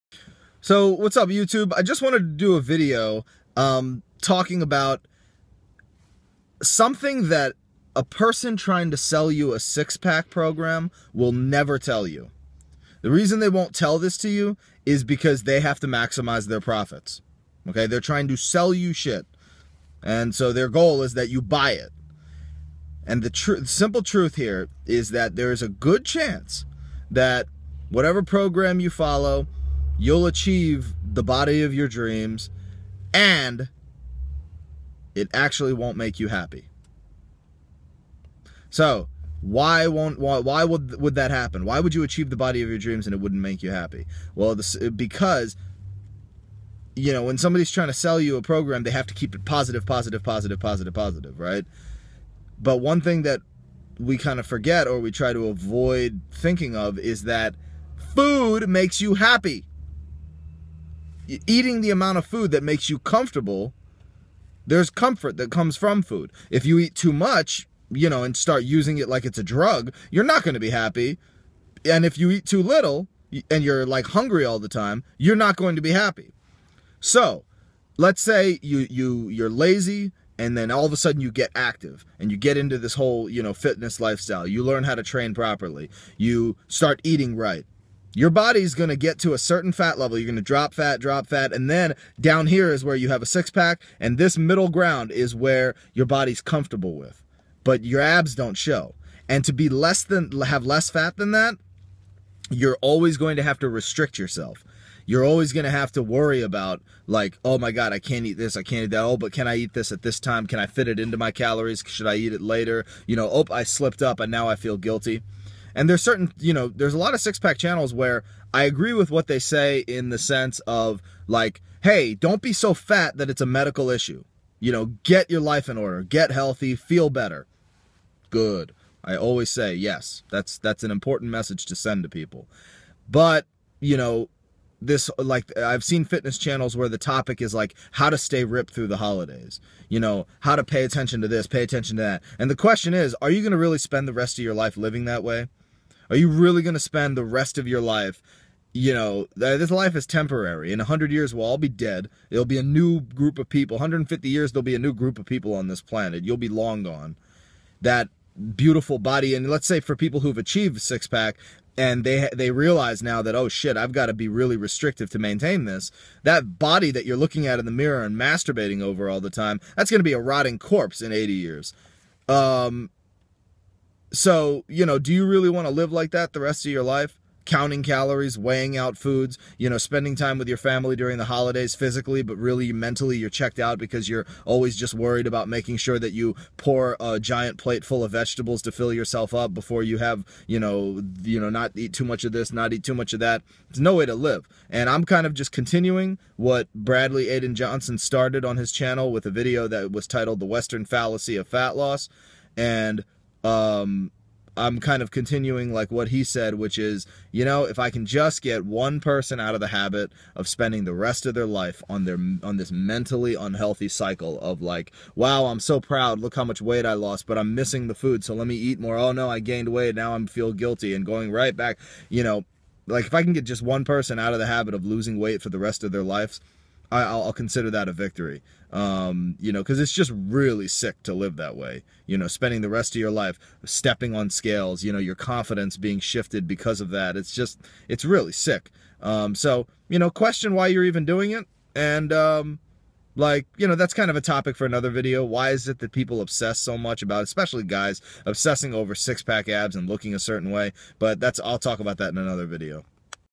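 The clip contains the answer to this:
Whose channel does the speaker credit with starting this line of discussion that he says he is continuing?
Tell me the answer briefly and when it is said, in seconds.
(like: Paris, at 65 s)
Bradley Aiden Johnson, at 196 s.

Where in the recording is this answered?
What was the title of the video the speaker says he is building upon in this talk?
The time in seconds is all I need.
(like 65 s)
200 s.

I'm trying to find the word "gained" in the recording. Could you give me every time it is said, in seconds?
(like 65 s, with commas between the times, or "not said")
219 s.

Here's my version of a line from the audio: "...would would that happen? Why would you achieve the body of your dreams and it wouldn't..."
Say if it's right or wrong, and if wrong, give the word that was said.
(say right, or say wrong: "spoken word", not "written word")
right.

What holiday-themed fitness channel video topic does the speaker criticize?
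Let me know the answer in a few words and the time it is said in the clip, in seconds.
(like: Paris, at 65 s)
How to stay ripped through the holidays, at 137 s.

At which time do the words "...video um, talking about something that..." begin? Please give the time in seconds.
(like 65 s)
2 s.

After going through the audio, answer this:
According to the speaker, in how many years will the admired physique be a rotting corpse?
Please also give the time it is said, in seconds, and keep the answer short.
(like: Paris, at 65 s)
80 years, at 171 s.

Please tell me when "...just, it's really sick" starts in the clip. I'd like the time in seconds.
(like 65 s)
237 s.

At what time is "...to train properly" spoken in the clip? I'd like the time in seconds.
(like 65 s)
84 s.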